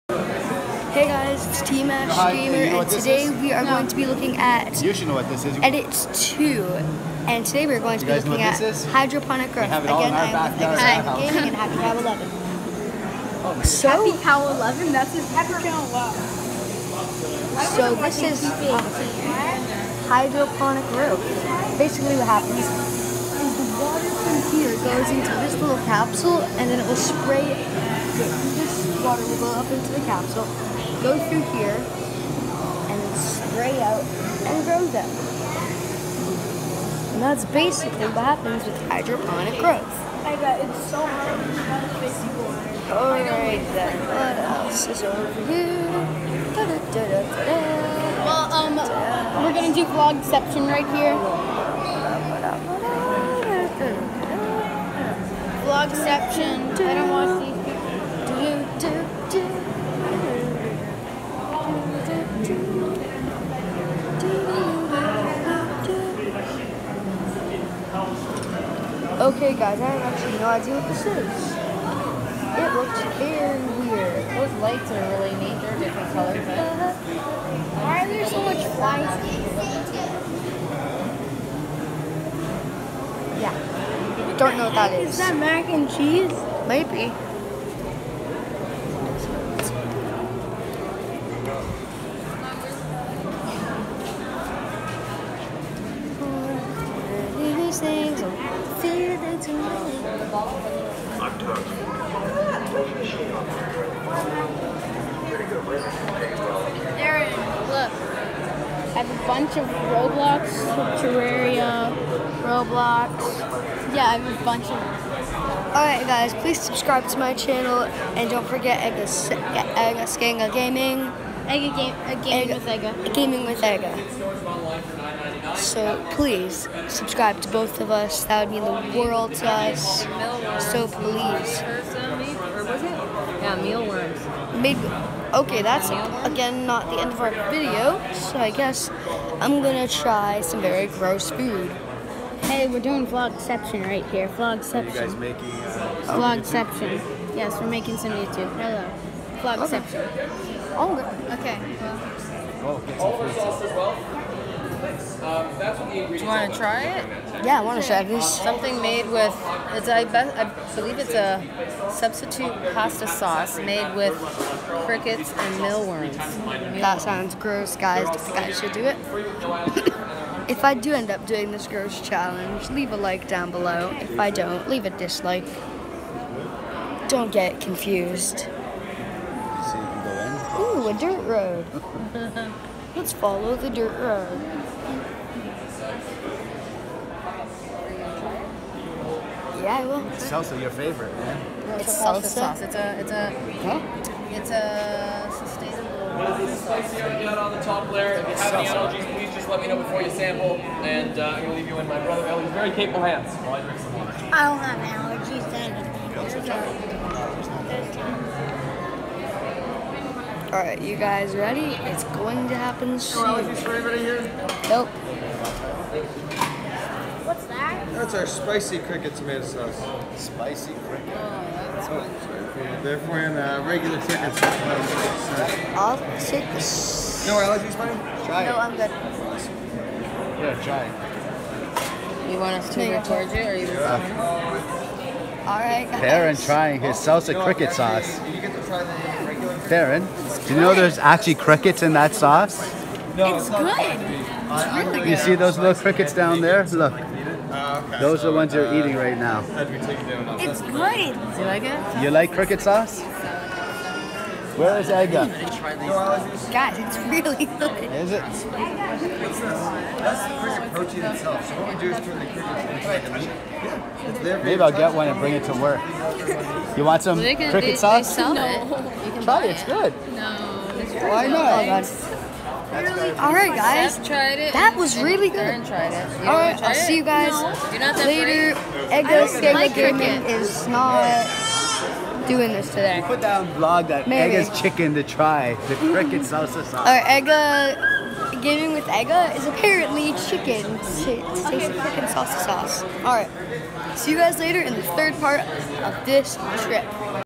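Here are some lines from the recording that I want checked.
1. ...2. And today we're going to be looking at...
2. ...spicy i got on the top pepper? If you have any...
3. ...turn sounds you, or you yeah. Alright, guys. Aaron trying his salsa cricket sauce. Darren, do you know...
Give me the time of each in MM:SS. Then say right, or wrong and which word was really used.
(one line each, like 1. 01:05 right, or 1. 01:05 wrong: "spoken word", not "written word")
1. 00:06 right
2. 03:16 wrong: "layer", not "pepper"
3. 03:52 wrong: "towards", not "sounds".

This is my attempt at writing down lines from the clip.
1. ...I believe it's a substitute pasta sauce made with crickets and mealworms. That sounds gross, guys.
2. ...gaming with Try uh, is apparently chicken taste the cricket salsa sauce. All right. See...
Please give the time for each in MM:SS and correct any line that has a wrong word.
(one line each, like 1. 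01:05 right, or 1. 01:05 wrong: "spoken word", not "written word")
1. 02:40 right
2. 04:48 wrong: "Egga", not "Try".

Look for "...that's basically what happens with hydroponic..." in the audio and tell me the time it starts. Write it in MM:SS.
00:37.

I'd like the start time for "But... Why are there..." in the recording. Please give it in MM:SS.
01:16.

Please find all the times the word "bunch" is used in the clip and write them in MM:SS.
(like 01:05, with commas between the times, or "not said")
01:49, 01:54.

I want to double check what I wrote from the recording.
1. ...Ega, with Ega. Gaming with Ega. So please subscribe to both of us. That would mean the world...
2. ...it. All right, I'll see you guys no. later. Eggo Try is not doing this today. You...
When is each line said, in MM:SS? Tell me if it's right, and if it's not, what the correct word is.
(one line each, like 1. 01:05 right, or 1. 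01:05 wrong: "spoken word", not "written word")
1. 02:02 right
2. 04:35 wrong: "Egga", not "Try".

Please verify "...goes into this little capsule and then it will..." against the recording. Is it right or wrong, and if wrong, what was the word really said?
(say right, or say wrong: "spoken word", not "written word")
right.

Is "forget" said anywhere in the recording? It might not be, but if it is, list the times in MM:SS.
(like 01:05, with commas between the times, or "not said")
01:58.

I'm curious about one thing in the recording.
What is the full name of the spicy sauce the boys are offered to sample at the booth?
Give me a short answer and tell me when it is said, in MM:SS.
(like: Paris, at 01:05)
Spicy cricket tomato sauce, at 03:38.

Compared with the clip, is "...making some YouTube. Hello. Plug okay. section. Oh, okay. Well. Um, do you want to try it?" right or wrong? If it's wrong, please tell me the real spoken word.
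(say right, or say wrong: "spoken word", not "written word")
right.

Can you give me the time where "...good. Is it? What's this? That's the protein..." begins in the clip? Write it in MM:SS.
04:17.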